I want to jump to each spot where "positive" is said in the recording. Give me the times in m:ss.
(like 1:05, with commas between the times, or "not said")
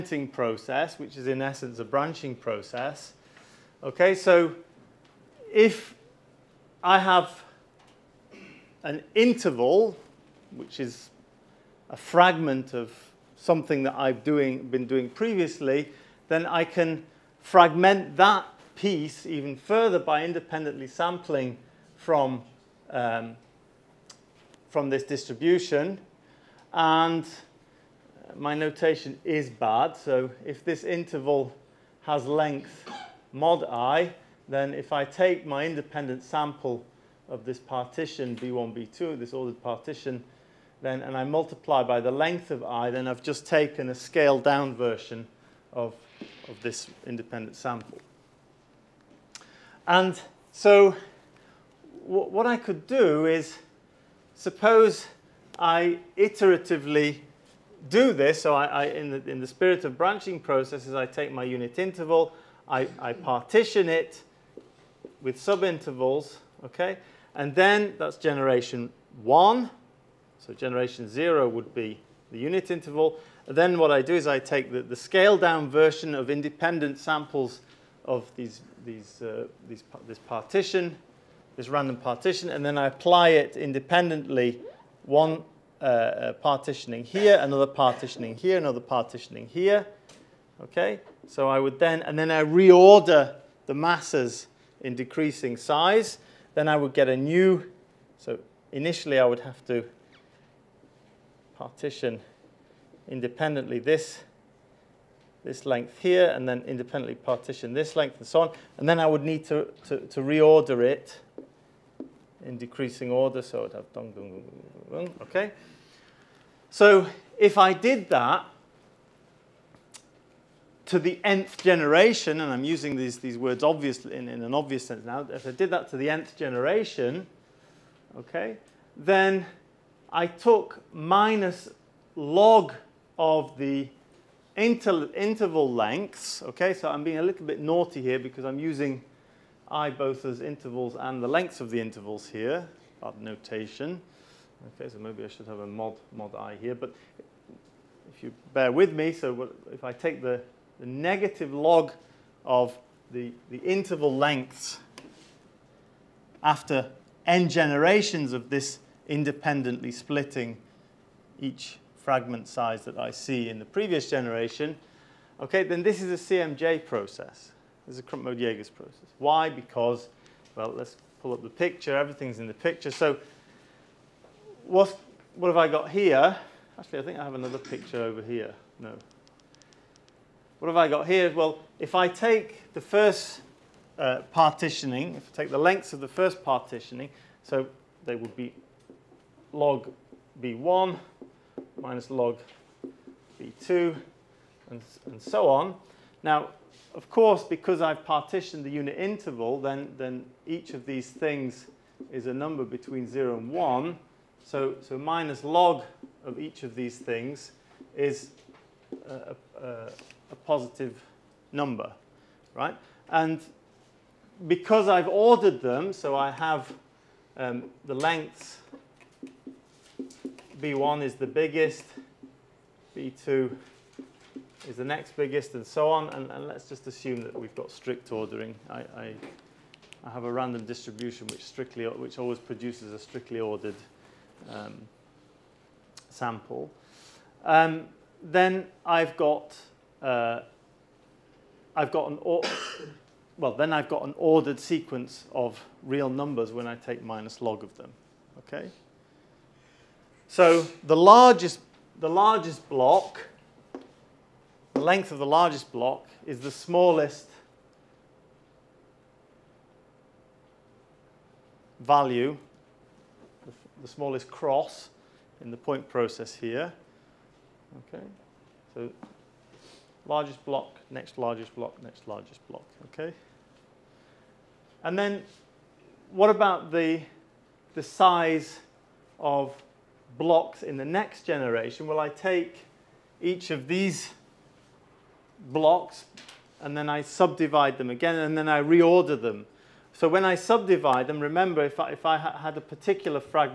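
3:30.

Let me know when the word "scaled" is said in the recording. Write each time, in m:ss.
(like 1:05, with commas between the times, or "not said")
0:43, 1:14.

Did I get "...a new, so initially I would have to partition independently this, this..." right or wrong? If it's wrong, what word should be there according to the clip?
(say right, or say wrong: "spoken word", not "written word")
right.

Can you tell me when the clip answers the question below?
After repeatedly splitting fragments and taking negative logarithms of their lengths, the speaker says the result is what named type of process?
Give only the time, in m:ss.
2:48.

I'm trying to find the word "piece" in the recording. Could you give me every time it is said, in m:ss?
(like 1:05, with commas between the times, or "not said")
0:18.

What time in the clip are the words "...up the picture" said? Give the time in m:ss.
2:51.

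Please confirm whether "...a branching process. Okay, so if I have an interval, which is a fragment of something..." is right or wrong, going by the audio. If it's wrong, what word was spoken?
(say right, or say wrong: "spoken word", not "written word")
right.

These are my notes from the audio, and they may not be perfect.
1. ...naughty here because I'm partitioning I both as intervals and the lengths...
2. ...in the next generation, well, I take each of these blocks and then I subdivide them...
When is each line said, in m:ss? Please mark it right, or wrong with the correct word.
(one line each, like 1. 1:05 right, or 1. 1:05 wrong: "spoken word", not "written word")
1. 2:17 wrong: "using", not "partitioning"
2. 4:40 right.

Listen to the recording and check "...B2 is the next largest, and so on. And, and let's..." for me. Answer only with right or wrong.
wrong.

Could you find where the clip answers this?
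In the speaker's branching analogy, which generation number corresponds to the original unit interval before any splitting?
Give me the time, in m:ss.
1:10.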